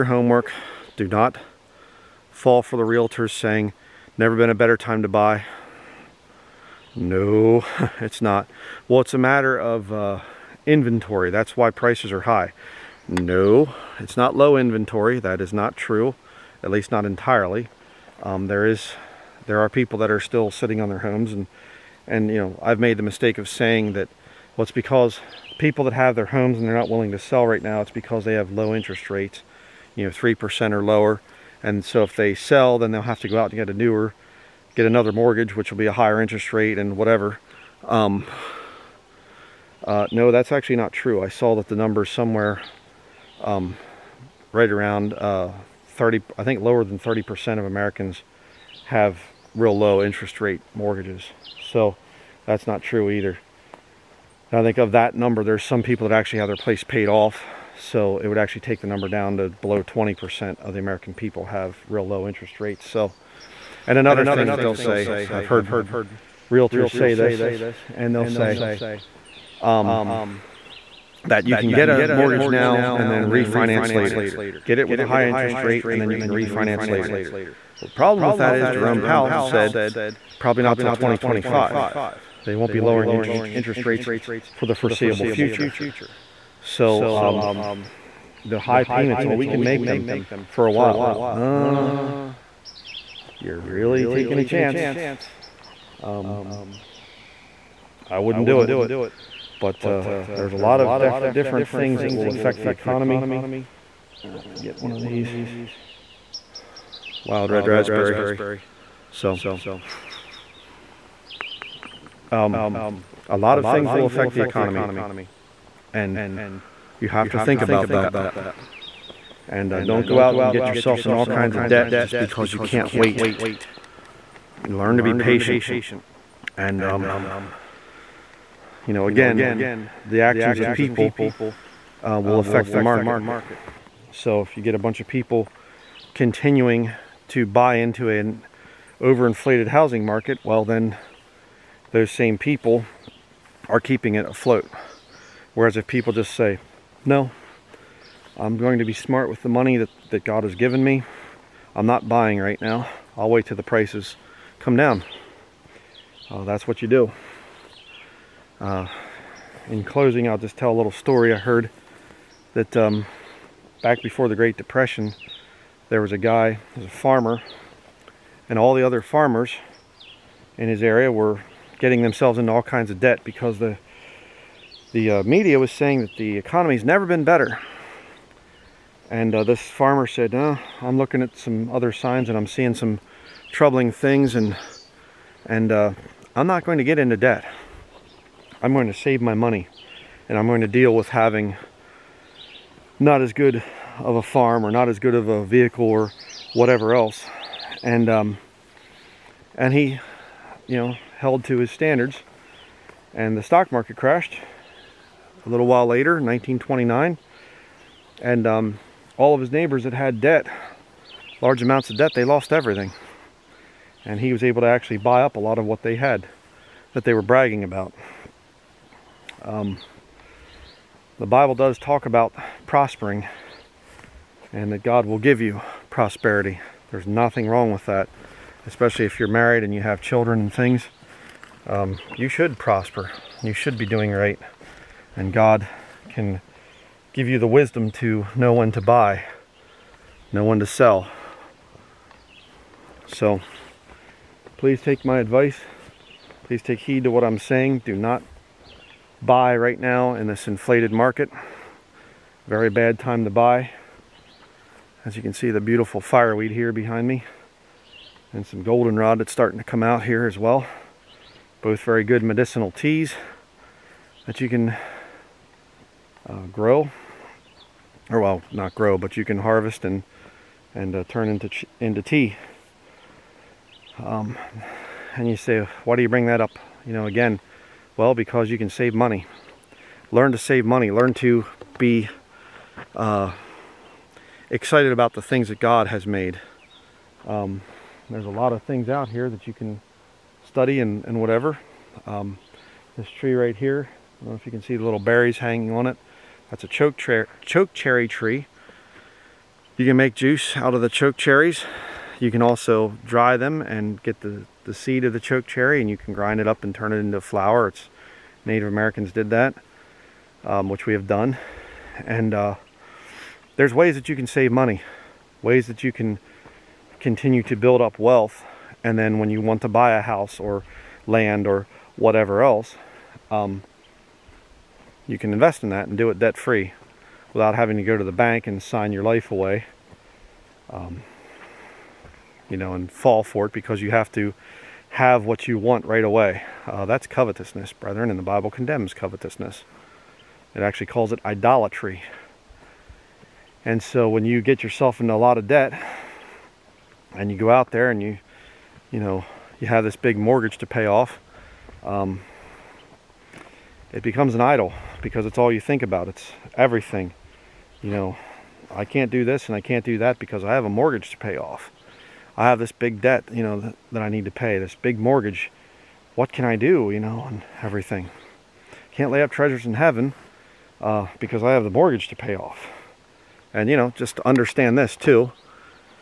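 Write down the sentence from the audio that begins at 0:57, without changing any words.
So it would actually take the number down to below 20% of the American people have real low interest rates.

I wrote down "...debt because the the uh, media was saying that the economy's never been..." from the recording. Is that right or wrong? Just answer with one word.
right.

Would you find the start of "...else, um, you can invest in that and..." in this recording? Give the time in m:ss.
5:22.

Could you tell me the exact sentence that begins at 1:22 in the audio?
They won't be lowering interest, interest rates for the foreseeable future.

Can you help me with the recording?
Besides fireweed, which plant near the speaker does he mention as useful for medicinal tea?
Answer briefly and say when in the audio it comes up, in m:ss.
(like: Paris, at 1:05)
goldenrod, at 4:18.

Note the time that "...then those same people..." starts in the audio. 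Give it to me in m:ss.
2:20.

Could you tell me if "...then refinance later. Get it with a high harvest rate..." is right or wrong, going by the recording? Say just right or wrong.
wrong.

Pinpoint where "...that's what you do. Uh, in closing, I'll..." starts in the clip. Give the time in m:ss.
2:36.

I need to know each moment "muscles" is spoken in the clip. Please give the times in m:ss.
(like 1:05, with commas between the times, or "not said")
not said.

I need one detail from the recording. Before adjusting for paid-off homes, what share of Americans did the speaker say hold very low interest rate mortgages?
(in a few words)
lower than 30%.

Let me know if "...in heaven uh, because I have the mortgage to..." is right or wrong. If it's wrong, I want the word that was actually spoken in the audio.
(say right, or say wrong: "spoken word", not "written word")
right.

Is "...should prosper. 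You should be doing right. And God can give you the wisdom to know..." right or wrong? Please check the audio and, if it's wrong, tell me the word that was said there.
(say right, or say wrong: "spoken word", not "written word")
right.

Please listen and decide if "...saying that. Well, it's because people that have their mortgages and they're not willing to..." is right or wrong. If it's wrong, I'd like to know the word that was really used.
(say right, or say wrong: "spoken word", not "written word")
wrong: "homes", not "mortgages".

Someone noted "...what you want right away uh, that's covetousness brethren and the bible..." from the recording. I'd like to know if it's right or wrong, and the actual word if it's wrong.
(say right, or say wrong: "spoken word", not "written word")
right.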